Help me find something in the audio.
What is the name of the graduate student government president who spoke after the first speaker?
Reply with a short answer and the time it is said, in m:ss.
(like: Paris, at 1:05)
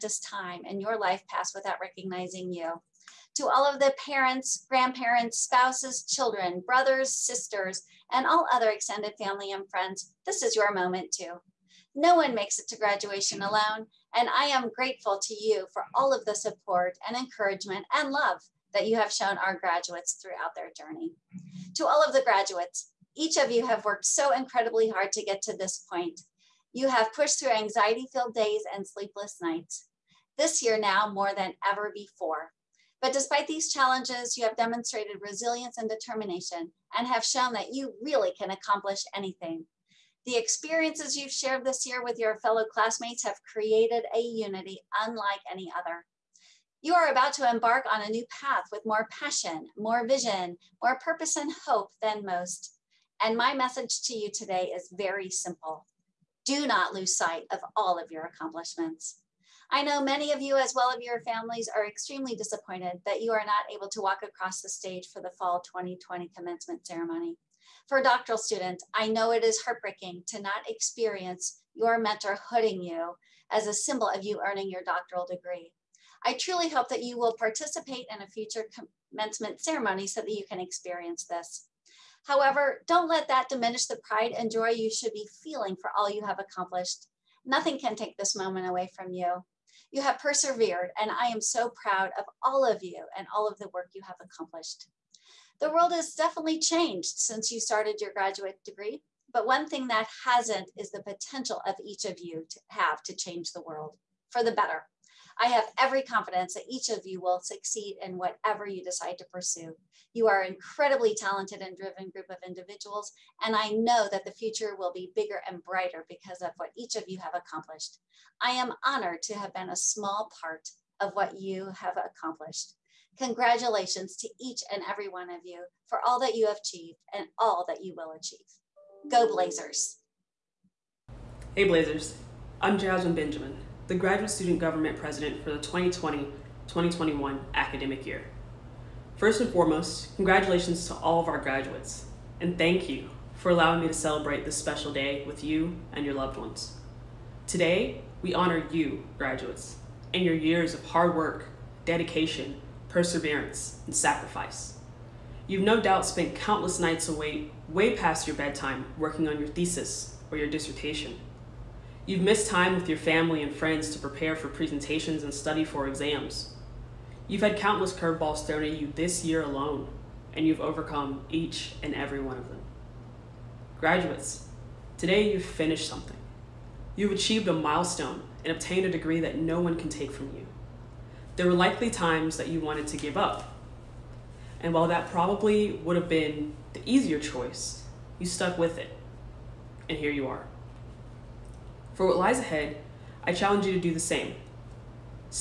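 Jasmine Benjamin, at 2:12.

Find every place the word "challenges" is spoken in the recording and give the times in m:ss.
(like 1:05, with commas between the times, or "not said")
0:33, 3:13.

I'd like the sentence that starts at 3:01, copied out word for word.
There were likely times that you wanted to give up.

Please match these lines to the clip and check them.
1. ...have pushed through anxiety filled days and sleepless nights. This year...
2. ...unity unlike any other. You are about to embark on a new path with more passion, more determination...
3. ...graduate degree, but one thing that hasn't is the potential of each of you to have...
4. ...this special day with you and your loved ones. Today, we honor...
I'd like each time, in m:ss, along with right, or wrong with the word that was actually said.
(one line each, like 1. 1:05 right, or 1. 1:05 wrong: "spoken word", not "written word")
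1. 0:26 right
2. 0:44 wrong: "vision", not "determination"
3. 1:38 right
4. 2:24 right.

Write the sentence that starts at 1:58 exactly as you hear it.
I am honored to have been a small part of what you have accomplished.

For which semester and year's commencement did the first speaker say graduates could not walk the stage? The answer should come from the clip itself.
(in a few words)
fall 2020.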